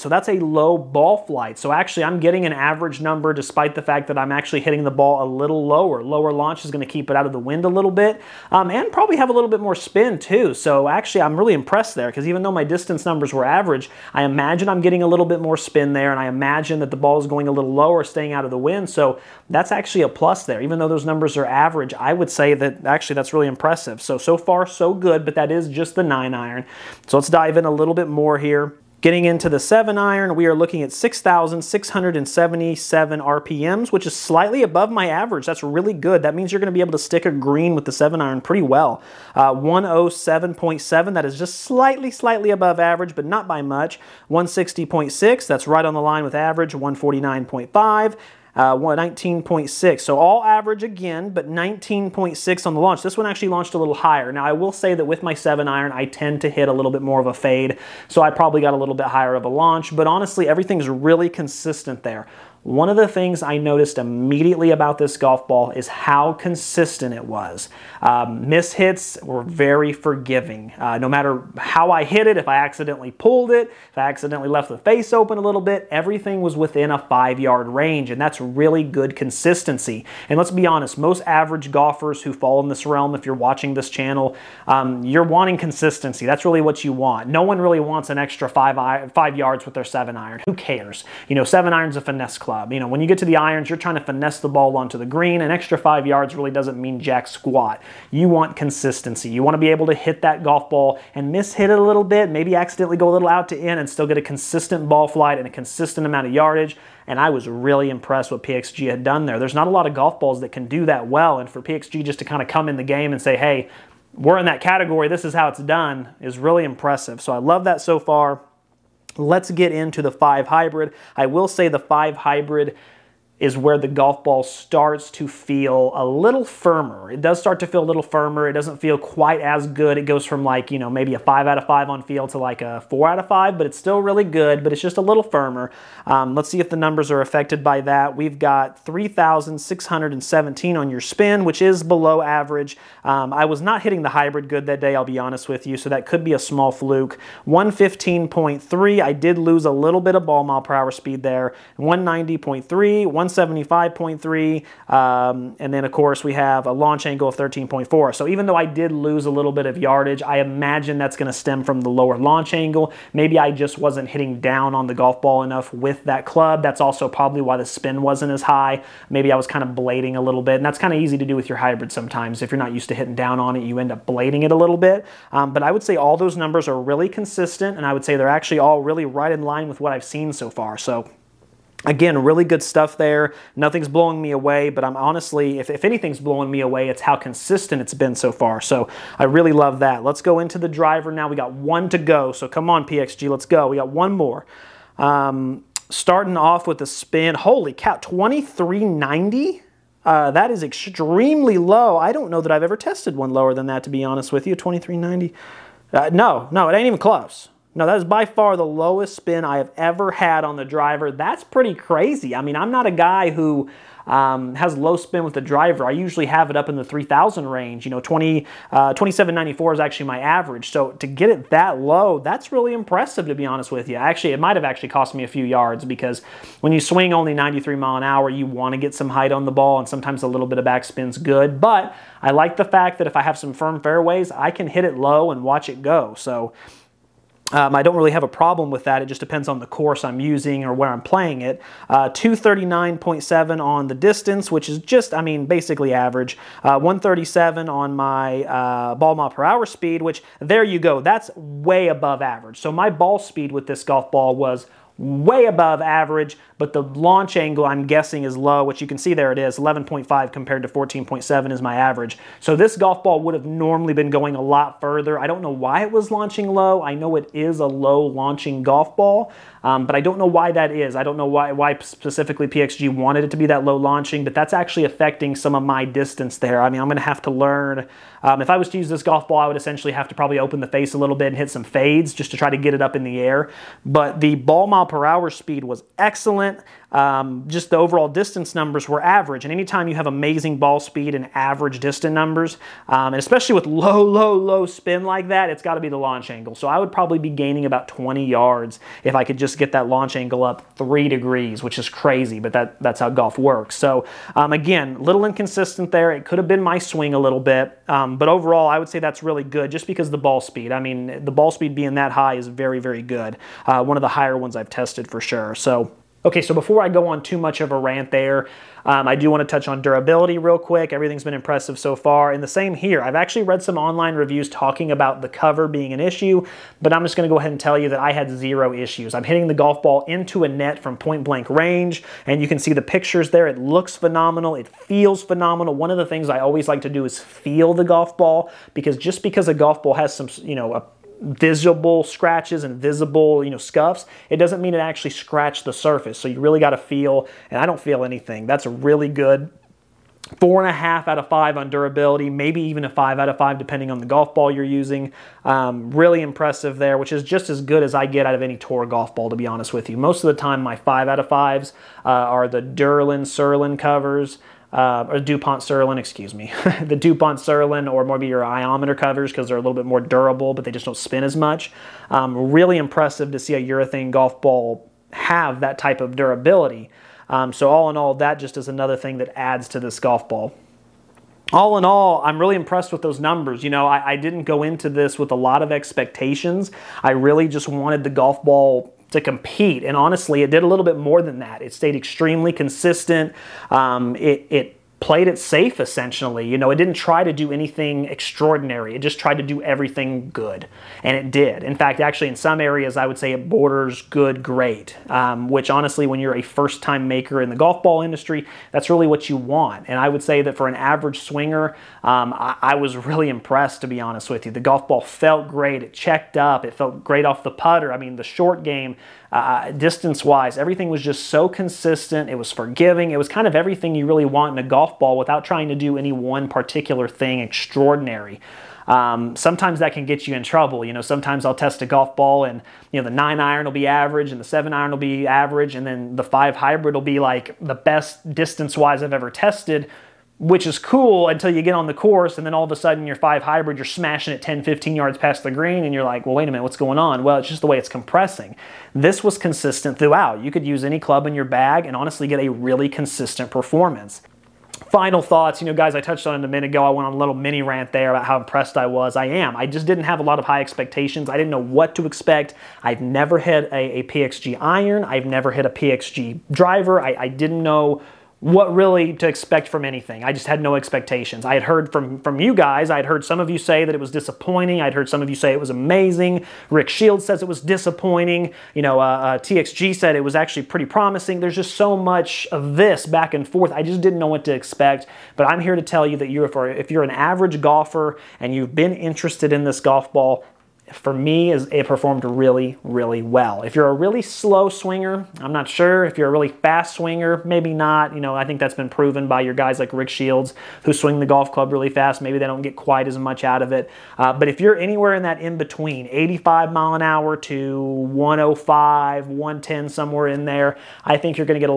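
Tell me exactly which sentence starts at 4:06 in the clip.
Uh, 137 on my uh, ball mile per hour speed, which there you go.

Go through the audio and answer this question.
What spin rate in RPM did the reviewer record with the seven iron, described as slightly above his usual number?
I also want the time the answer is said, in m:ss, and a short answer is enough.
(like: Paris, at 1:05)
6,677, at 0:30.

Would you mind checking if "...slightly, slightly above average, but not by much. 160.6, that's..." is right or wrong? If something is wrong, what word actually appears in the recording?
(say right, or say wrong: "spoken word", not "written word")
right.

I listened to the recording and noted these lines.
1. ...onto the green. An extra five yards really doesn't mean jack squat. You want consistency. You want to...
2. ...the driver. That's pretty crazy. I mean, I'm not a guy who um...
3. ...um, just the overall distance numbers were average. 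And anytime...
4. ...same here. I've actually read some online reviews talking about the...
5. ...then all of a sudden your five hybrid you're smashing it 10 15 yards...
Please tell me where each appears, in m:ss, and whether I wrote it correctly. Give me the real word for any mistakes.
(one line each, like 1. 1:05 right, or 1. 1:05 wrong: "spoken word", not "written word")
1. 1:34 right
2. 3:30 right
3. 4:46 right
4. 5:22 right
5. 7:22 right.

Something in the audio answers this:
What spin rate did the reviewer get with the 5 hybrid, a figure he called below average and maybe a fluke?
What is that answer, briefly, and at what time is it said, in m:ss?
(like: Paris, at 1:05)
3,617, at 2:18.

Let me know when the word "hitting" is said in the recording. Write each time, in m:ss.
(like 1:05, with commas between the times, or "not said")
0:04, 2:23, 2:44, 2:52, 5:29.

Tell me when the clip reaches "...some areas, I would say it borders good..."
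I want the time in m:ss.
6:42.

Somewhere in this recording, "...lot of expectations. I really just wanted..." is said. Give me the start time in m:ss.
6:25.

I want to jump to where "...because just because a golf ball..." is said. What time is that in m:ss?
5:38.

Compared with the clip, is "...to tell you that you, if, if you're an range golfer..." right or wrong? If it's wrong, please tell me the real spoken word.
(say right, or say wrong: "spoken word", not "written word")
wrong: "average", not "range".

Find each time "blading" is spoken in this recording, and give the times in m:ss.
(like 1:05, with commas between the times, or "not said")
2:49, 2:54.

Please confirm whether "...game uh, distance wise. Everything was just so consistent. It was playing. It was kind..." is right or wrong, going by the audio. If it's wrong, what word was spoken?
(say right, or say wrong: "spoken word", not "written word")
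wrong: "forgiving", not "playing".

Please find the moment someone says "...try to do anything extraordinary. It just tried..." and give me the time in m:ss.
6:36.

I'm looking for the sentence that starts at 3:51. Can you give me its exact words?
But I like the fact that if I have some firm fairways, I can hit it low and watch it go.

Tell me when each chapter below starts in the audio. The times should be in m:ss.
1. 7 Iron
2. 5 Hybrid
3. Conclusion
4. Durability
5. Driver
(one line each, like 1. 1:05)
1. 0:28
2. 2:17
3. 6:21
4. 5:15
5. 3:14.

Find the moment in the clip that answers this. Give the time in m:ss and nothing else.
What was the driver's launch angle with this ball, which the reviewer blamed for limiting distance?
4:19.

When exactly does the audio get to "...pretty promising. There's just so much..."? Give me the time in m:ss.
8:00.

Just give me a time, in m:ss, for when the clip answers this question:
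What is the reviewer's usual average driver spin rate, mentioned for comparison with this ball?
3:38.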